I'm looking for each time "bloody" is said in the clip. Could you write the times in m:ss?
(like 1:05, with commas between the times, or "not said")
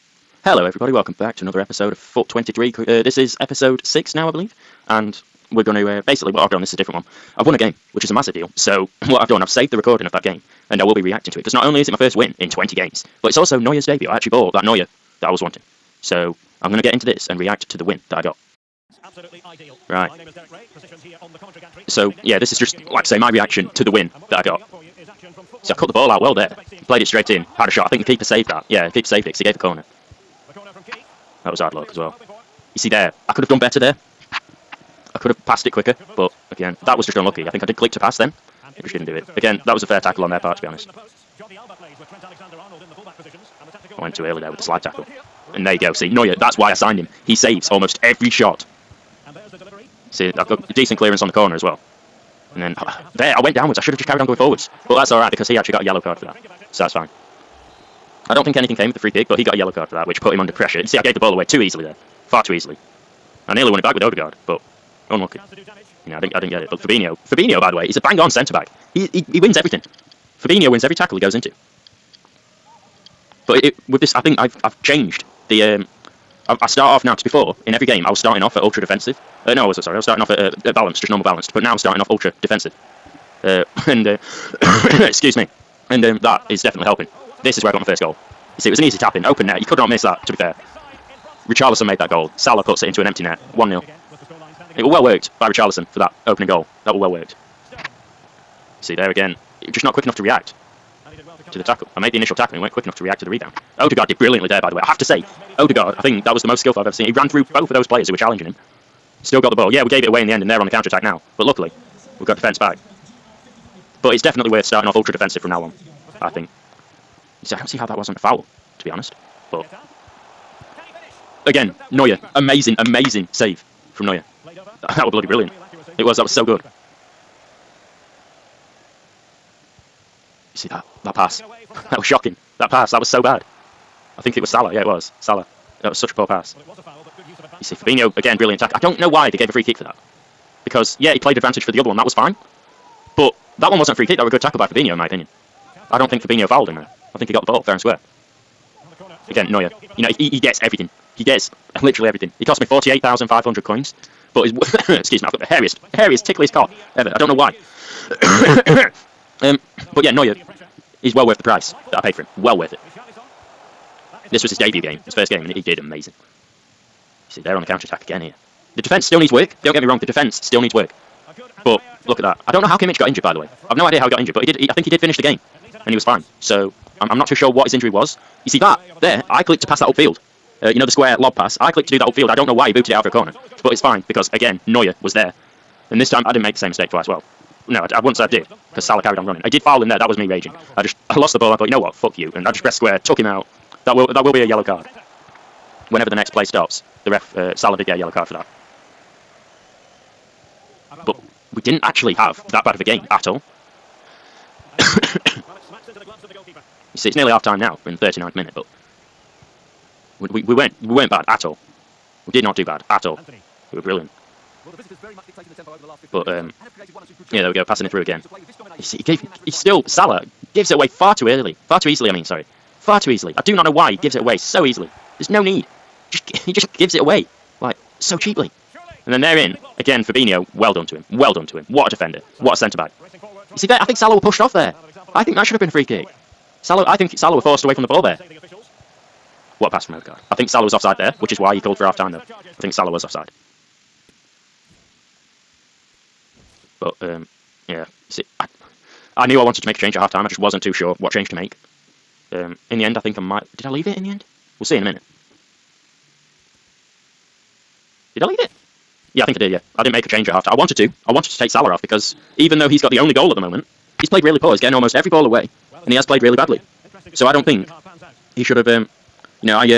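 2:05.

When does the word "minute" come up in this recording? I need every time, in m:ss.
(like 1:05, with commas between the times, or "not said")
3:28, 4:14.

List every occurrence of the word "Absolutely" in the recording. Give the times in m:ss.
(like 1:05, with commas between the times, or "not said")
0:19.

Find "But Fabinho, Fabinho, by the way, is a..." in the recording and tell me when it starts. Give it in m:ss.
1:06.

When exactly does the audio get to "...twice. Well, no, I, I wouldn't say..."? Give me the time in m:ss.
3:06.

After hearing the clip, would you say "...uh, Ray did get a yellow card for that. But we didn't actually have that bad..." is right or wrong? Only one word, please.
wrong.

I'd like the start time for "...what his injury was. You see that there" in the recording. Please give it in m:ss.
2:57.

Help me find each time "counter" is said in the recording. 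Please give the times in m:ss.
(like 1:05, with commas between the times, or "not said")
1:50, 2:47.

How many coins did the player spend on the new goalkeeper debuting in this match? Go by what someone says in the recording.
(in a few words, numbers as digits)
48,500.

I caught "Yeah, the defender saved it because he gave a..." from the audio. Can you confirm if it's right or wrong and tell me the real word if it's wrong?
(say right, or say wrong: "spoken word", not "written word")
wrong: "keeper", not "defender".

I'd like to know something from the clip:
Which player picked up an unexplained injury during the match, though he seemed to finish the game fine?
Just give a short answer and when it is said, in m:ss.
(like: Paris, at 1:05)
Kimmich, at 2:52.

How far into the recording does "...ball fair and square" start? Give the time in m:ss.
2:27.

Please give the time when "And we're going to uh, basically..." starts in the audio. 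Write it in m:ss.
0:04.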